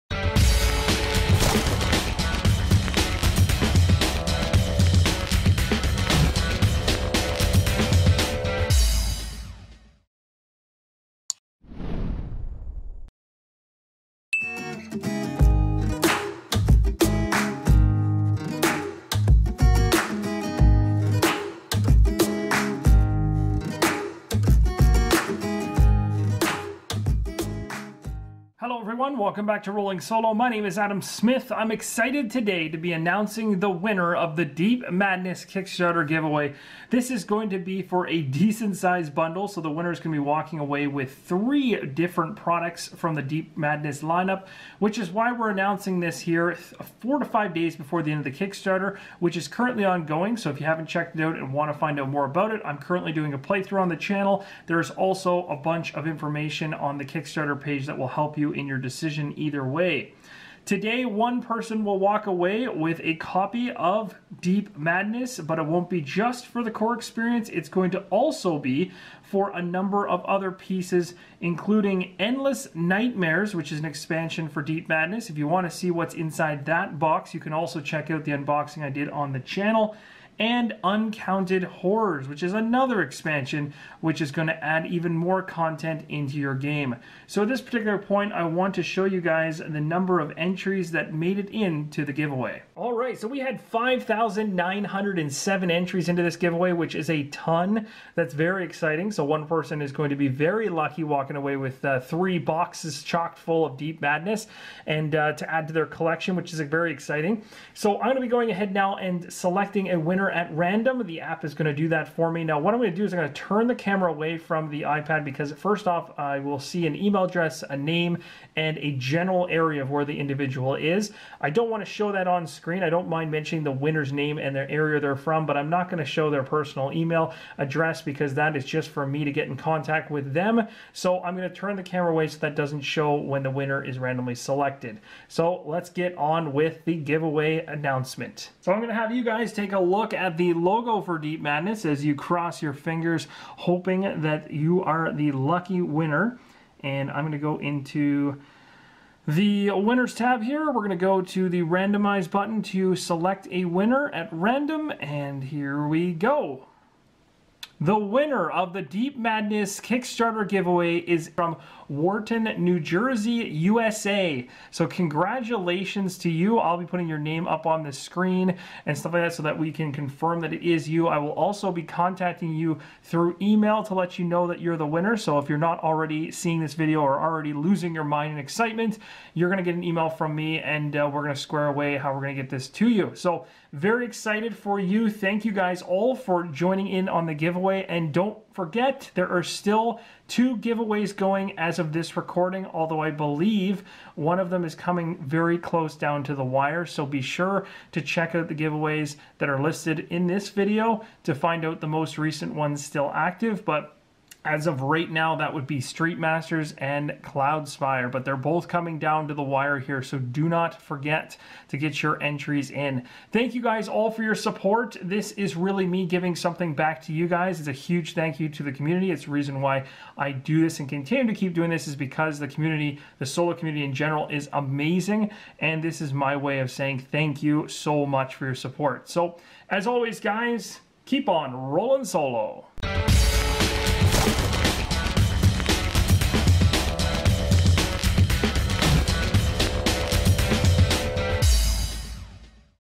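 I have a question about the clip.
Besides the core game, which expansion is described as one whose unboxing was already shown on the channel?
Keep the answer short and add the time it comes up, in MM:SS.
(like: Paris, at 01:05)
Endless Nightmares, at 01:12.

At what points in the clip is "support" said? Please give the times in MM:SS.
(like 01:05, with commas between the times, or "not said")
03:34, 03:48.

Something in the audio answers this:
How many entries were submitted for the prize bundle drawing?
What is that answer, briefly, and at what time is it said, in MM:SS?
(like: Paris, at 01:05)
5,907, at 01:33.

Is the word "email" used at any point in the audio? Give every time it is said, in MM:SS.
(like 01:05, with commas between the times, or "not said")
01:56, 02:06, 02:53, 02:59.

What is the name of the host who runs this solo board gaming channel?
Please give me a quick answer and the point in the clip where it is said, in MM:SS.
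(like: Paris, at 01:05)
Adam Smith, at 00:30.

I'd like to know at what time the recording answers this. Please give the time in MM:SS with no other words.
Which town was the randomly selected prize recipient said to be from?
02:41.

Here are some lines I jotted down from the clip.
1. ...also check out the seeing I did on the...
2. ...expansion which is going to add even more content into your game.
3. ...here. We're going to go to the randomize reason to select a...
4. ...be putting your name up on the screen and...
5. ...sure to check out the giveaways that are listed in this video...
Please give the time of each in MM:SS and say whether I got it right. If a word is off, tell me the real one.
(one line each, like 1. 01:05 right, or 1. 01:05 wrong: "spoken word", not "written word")
1. 01:17 wrong: "unboxing", not "seeing"
2. 01:23 right
3. 02:30 wrong: "button", not "reason"
4. 02:46 right
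5. 03:17 right.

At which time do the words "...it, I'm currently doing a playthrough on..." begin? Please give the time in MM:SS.
00:52.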